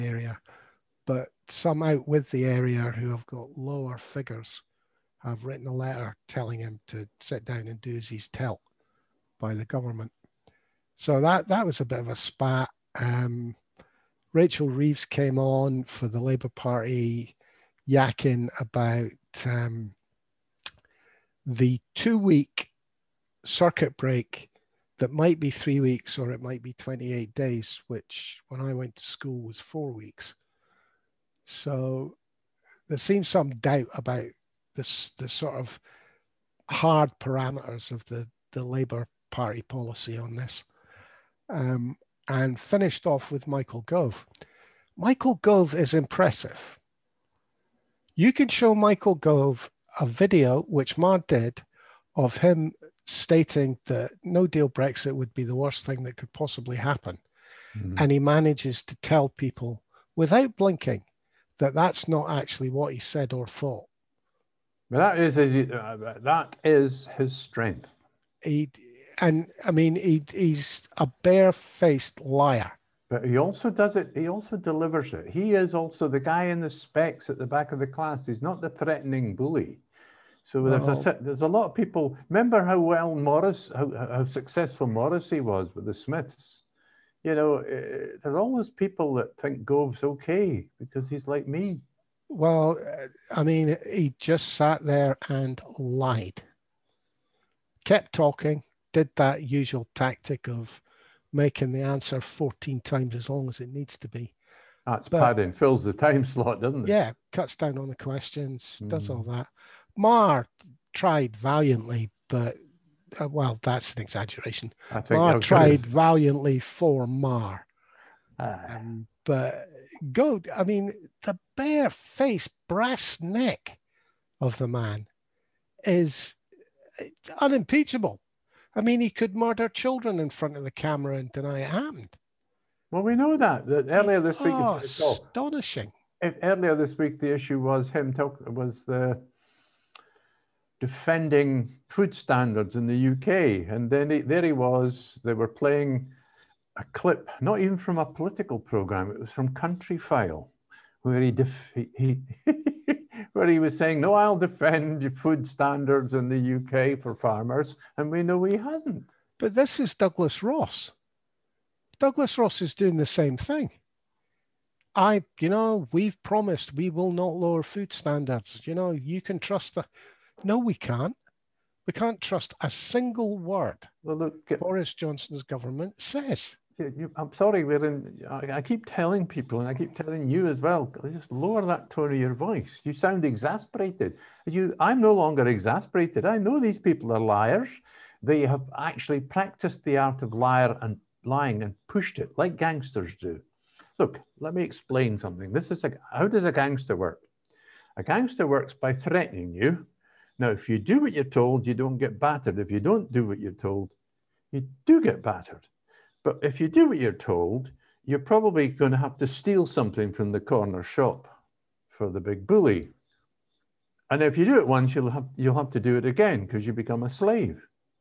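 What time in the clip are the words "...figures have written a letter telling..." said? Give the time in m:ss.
0:03.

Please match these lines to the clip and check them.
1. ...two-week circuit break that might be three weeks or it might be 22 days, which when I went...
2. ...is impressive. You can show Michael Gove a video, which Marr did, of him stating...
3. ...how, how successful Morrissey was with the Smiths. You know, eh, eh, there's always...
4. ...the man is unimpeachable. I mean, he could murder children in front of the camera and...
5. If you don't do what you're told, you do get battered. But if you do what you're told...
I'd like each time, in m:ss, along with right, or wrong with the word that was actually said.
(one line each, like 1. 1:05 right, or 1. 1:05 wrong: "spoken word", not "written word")
1. 0:21 wrong: "28", not "22"
2. 0:45 right
3. 1:23 right
4. 2:04 right
5. 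3:22 right.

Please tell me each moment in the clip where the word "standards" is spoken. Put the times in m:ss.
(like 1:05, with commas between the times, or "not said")
2:22, 2:35, 2:47.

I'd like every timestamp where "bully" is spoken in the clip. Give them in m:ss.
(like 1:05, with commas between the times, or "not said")
1:19, 3:32.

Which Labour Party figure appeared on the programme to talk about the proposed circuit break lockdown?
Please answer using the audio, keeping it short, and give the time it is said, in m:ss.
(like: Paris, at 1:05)
Rachel Reeves, at 0:14.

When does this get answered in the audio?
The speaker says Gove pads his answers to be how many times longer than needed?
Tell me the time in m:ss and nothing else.
1:42.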